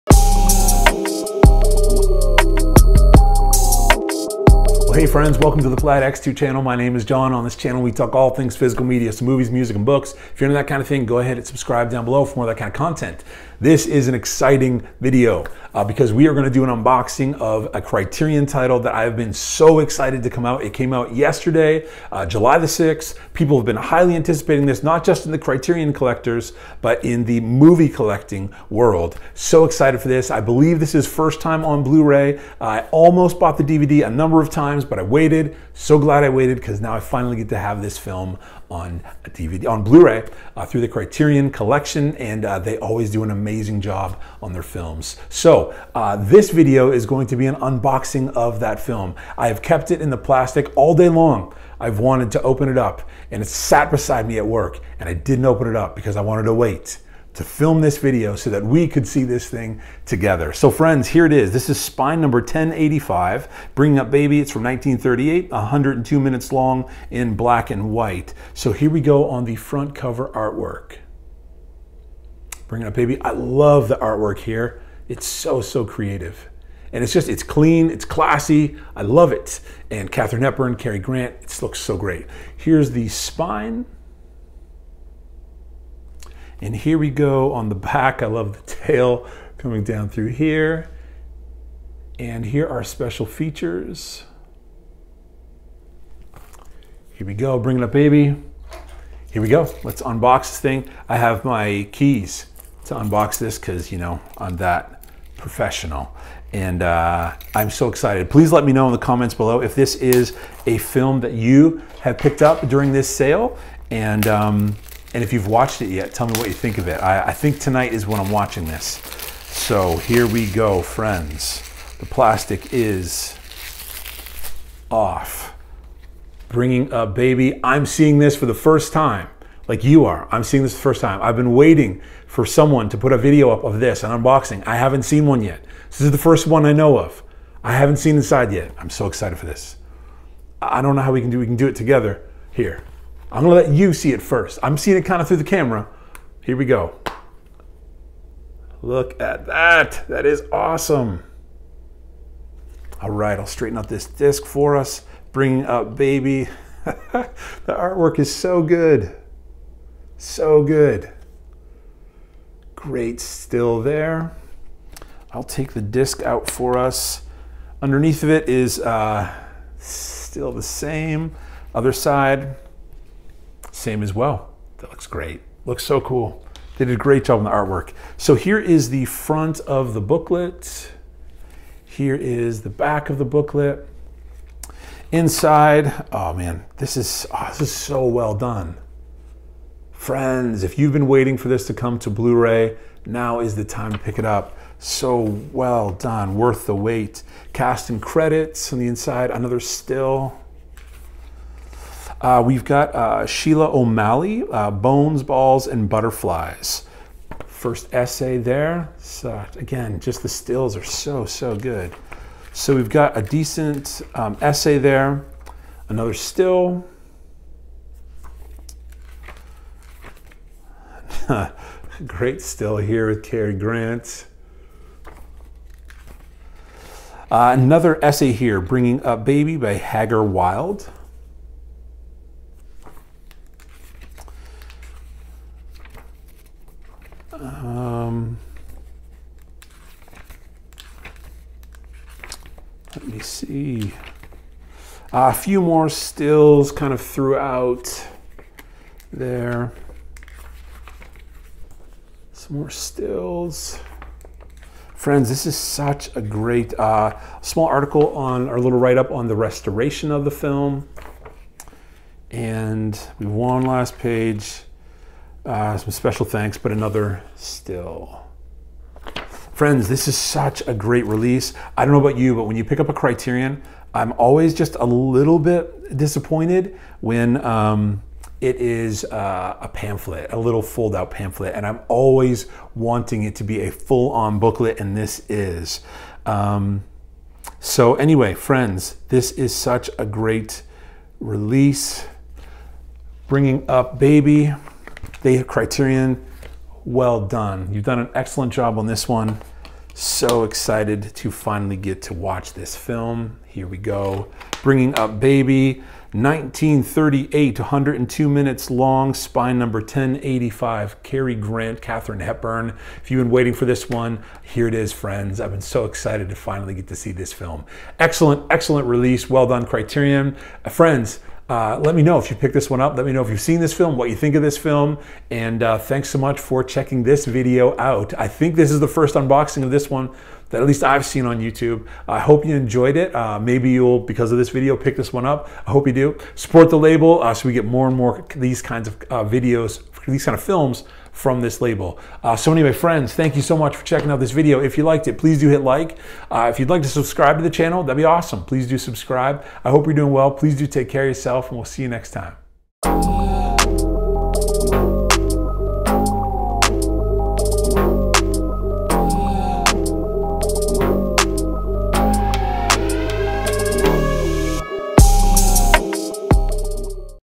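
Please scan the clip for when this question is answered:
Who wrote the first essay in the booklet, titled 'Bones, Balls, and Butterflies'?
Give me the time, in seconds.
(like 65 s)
203 s.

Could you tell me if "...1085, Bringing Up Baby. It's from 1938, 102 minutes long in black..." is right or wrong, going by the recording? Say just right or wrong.
right.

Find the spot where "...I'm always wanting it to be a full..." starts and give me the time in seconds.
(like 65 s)
281 s.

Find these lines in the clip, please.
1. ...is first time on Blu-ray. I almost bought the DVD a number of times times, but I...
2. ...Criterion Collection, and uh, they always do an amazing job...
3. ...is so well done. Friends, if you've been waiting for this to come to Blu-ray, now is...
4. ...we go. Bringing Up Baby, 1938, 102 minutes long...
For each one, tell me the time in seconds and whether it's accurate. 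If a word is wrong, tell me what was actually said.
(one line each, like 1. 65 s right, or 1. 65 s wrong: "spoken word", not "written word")
1. 30 s right
2. 40 s right
3. 187 s right
4. 303 s right.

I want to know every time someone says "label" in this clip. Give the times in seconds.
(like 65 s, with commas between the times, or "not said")
336 s, 341 s.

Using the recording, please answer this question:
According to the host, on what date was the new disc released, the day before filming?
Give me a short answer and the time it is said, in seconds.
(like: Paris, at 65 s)
July 6th, at 22 s.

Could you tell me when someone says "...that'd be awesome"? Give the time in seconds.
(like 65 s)
347 s.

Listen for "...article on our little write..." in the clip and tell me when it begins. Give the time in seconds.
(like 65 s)
257 s.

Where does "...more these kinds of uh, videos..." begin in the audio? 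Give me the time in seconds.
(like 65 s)
337 s.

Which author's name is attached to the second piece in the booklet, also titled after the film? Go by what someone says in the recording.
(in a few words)
Hagar Wilde.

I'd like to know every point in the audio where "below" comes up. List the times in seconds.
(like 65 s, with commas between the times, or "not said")
12 s, 109 s.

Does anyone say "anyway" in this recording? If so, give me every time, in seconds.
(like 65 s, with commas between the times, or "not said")
287 s, 342 s.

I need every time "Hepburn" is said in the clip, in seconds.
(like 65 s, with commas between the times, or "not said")
80 s, 312 s.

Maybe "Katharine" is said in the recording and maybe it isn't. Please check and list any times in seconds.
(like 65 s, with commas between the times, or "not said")
80 s, 311 s.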